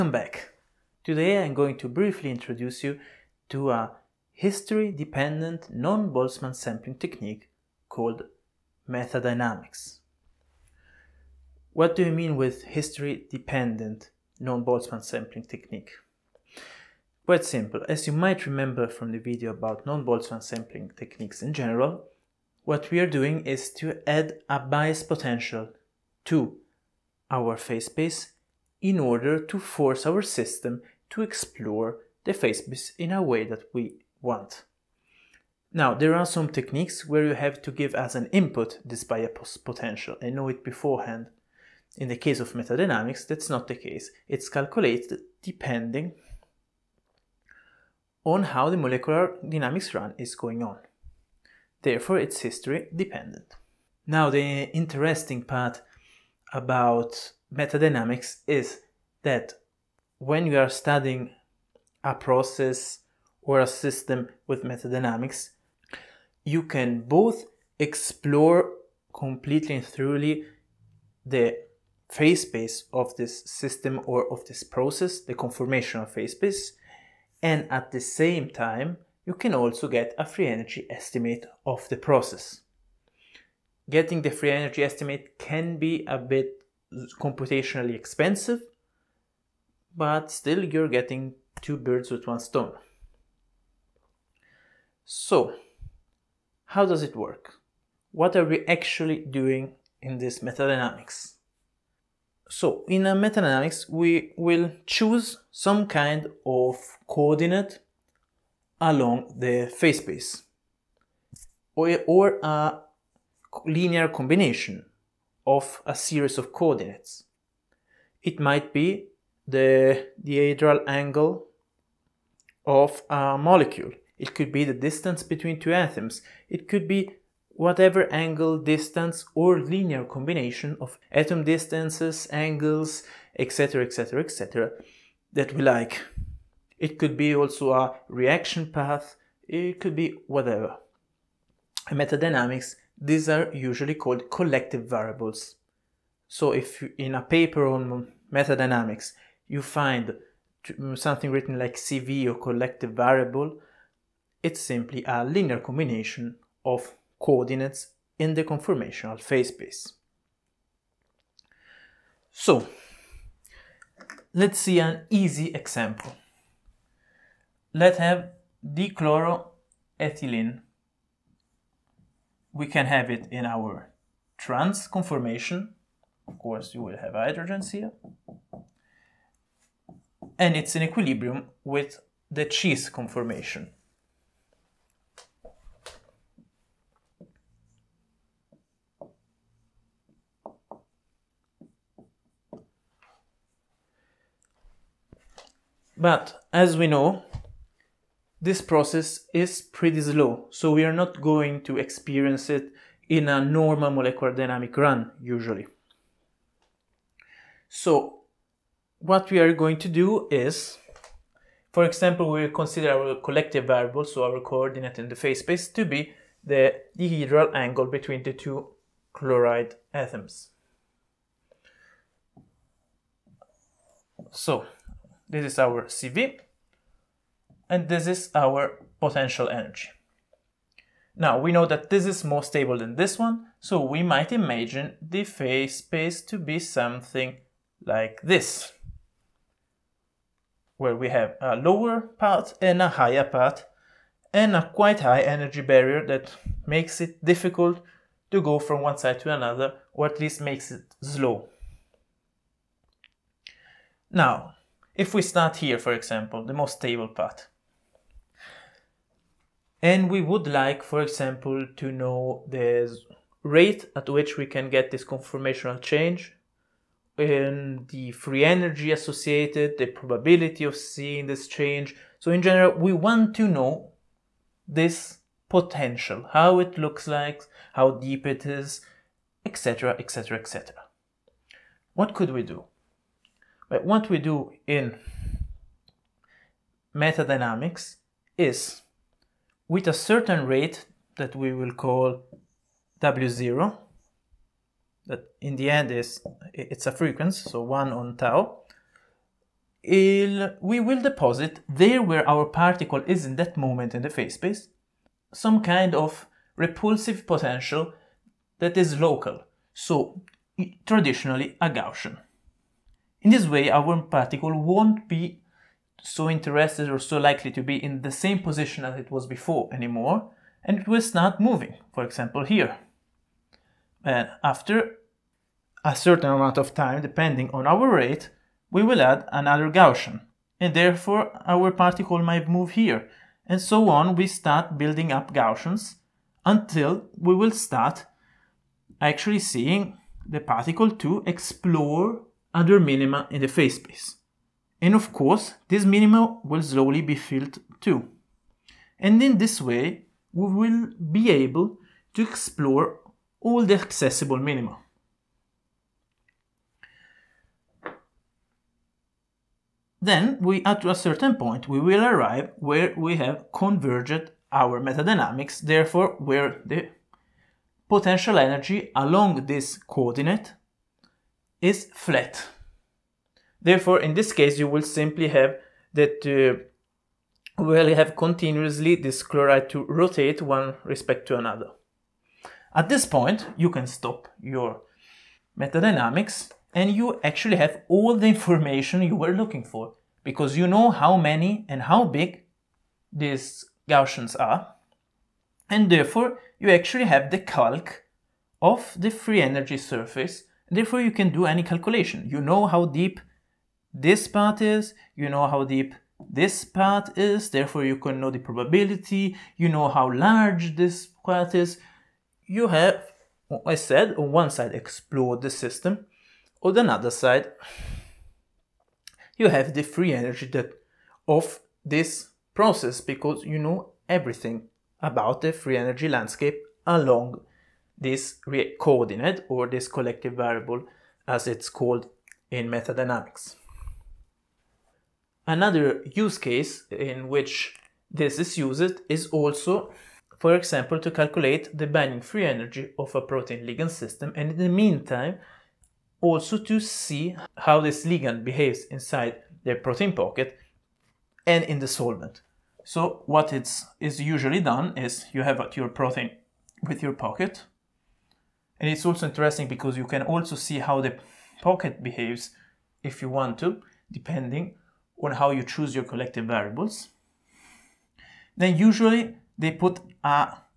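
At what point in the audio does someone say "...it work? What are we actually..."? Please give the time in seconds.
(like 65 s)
97 s.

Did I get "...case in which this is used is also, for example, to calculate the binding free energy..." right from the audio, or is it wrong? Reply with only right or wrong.
right.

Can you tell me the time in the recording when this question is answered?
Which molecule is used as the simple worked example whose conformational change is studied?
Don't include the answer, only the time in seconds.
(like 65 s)
168 s.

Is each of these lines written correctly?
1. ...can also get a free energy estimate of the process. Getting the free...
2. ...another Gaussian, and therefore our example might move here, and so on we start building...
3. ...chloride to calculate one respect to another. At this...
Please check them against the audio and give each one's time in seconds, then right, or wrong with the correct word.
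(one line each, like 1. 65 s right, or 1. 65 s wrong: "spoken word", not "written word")
1. 79 s right
2. 329 s wrong: "particle", not "example"
3. 379 s wrong: "rotate", not "calculate".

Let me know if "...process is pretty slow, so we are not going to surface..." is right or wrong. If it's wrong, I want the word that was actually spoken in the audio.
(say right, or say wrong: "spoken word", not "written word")
wrong: "experience", not "surface".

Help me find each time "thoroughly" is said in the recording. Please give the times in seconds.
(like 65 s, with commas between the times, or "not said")
69 s.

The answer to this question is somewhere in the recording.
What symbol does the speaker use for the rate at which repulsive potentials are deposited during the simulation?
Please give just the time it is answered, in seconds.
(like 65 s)
292 s.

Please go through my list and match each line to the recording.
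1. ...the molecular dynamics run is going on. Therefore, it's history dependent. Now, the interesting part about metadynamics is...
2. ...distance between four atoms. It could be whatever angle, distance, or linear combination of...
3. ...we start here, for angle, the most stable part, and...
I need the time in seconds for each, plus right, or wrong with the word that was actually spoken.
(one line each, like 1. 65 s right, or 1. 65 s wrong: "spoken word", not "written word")
1. 48 s right
2. 124 s wrong: "two", not "four"
3. 255 s wrong: "example", not "angle".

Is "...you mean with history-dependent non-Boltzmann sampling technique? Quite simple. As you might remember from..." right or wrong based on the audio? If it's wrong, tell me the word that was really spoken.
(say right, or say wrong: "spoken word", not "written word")
right.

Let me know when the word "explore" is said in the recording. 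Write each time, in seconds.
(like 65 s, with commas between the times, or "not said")
31 s, 67 s, 341 s, 352 s, 414 s.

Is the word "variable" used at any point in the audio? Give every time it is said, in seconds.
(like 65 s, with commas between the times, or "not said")
144 s, 152 s, 213 s, 430 s, 466 s.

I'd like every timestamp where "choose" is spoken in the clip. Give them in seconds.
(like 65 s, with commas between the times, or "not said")
104 s, 465 s.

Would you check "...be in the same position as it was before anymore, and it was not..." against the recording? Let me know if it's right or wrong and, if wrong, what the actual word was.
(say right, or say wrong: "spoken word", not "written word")
right.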